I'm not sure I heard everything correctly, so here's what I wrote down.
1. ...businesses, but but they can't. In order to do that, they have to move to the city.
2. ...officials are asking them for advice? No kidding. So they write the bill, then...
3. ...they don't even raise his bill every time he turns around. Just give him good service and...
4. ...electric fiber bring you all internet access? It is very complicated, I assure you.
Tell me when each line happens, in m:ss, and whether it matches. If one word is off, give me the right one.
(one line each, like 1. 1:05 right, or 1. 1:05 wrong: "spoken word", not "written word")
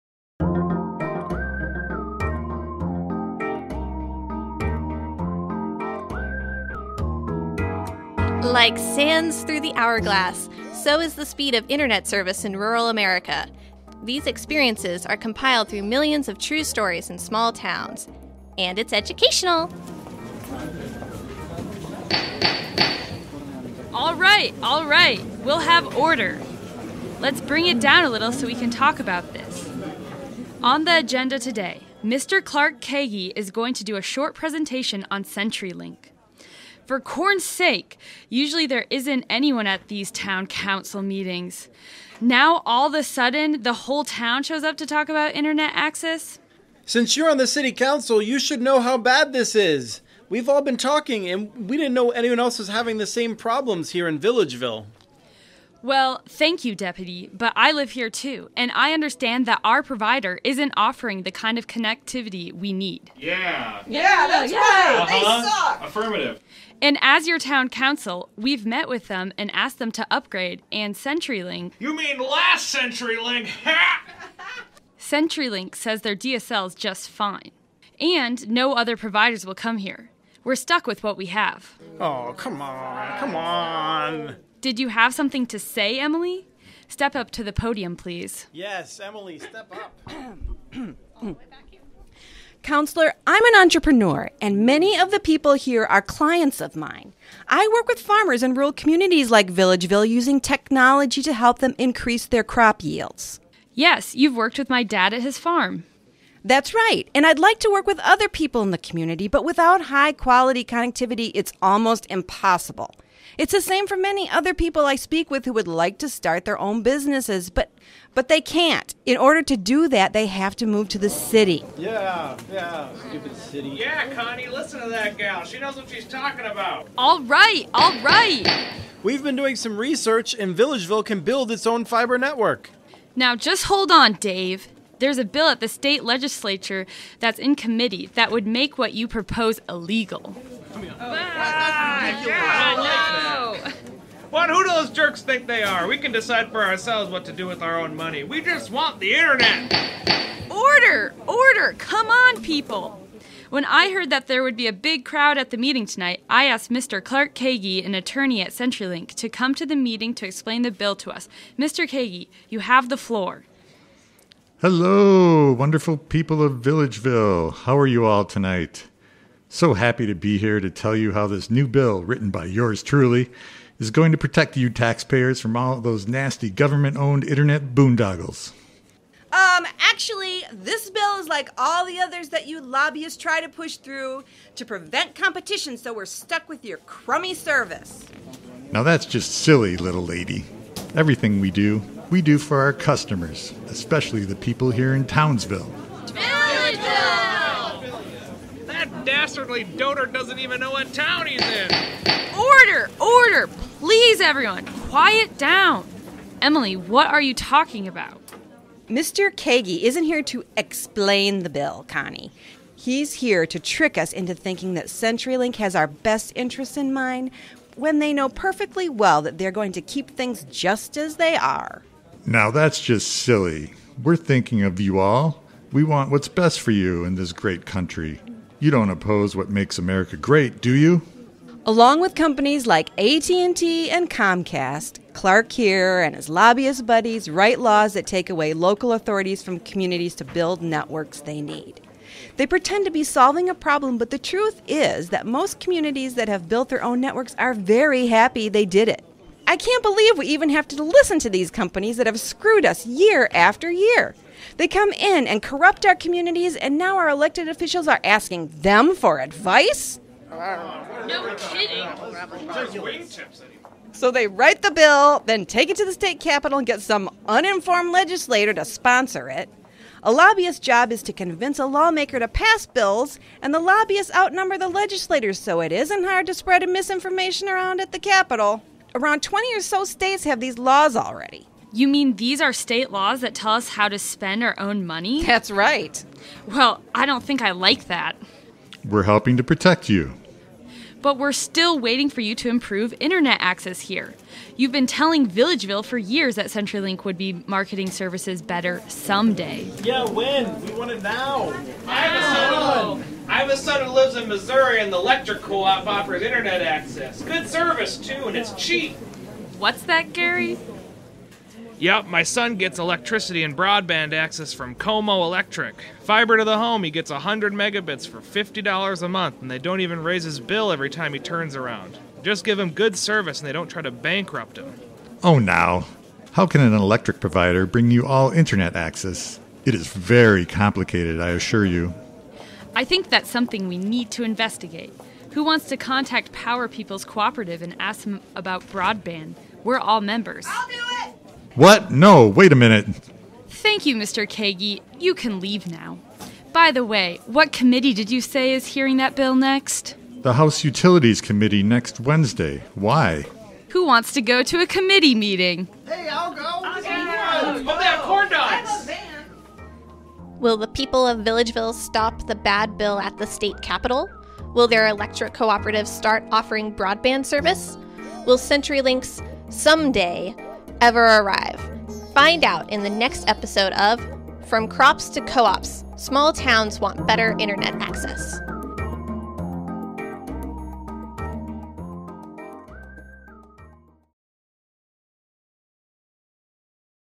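1. 1:56 right
2. 4:17 right
3. 5:19 right
4. 5:26 wrong: "provider", not "fiber".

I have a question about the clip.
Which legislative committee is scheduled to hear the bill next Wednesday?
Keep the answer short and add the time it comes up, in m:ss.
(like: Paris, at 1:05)
House Utilities Committee, at 5:50.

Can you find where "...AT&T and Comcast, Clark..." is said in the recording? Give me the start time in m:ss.
3:52.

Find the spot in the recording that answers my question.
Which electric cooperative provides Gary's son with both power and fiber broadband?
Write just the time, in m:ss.
5:14.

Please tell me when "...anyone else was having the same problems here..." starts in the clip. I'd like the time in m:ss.
0:52.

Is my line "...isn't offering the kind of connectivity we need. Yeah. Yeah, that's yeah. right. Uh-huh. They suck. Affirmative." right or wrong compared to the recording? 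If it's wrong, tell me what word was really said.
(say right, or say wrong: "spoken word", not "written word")
right.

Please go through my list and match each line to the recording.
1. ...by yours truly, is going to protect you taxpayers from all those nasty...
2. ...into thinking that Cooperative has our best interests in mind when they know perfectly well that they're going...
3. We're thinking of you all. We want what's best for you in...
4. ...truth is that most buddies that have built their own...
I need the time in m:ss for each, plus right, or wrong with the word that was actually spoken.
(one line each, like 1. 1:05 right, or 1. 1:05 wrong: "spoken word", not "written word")
1. 2:52 right
2. 3:34 wrong: "CenturyLink", not "Cooperative"
3. 3:44 right
4. 4:04 wrong: "communities", not "buddies".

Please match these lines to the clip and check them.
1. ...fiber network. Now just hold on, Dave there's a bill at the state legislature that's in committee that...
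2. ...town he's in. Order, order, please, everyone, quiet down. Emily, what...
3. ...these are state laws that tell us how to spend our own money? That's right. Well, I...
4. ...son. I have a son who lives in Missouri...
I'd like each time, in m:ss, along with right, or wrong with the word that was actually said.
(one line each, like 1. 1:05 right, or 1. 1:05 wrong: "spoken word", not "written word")
1. 2:11 right
2. 3:20 right
3. 4:42 right
4. 5:03 right.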